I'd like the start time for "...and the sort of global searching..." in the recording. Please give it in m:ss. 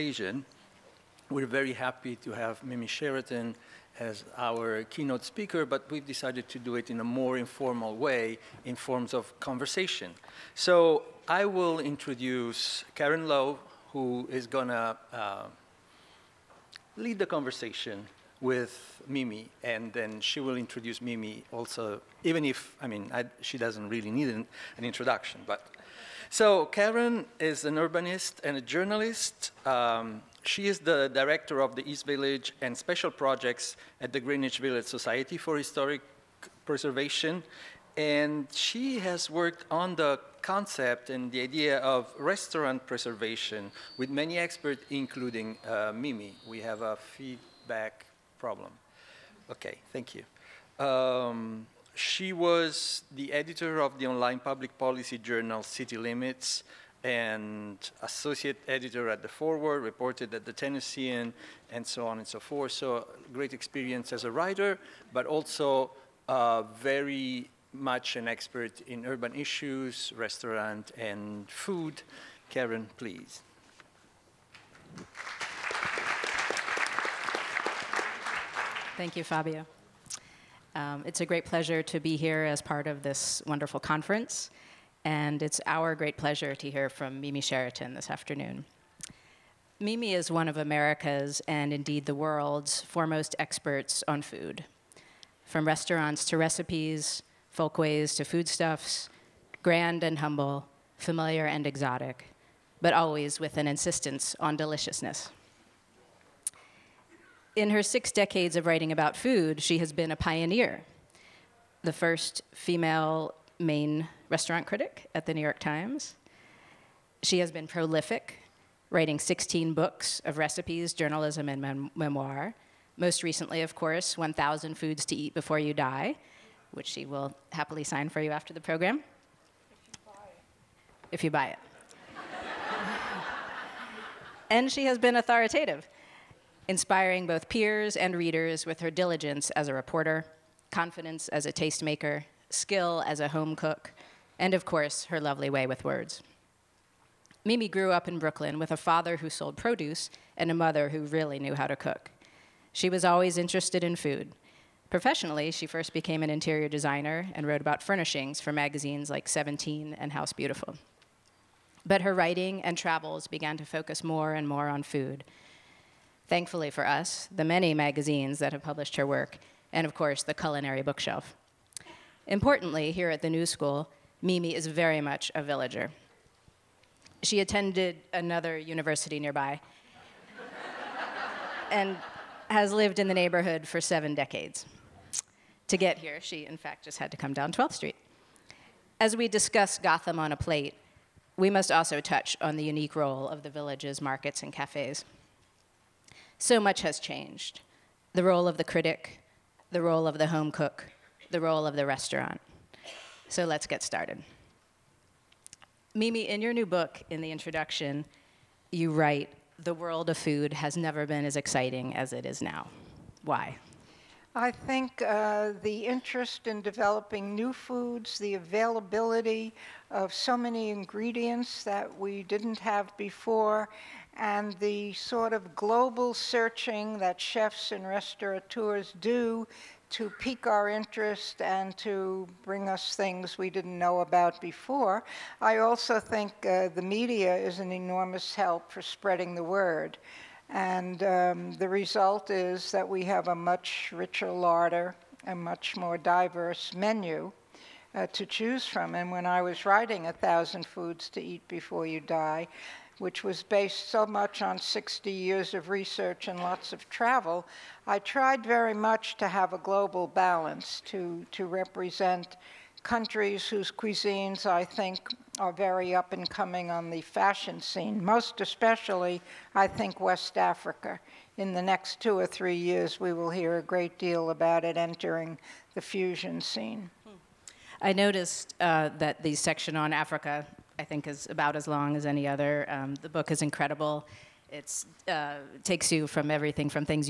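3:44.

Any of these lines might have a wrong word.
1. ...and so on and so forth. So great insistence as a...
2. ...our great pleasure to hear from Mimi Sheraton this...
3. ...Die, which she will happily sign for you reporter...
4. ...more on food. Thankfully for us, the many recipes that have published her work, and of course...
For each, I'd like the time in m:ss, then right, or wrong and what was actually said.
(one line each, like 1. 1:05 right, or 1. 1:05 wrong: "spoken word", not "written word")
1. 1:01 wrong: "experience", not "insistence"
2. 1:25 right
3. 2:05 wrong: "after", not "reporter"
4. 2:44 wrong: "magazines", not "recipes".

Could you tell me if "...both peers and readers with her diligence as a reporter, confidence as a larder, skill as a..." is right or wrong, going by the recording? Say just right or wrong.
wrong.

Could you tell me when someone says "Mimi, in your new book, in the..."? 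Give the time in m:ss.
3:25.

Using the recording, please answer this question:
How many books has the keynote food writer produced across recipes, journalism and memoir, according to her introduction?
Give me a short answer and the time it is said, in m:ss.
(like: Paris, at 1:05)
16, at 1:59.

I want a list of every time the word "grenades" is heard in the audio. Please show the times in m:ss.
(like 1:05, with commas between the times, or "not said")
not said.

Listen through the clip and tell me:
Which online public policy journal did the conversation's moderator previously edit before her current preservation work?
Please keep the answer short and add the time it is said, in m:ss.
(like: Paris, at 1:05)
City Limits, at 0:55.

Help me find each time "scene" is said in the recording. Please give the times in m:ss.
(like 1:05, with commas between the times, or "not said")
4:27, 4:36.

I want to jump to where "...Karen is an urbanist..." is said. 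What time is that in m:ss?
0:26.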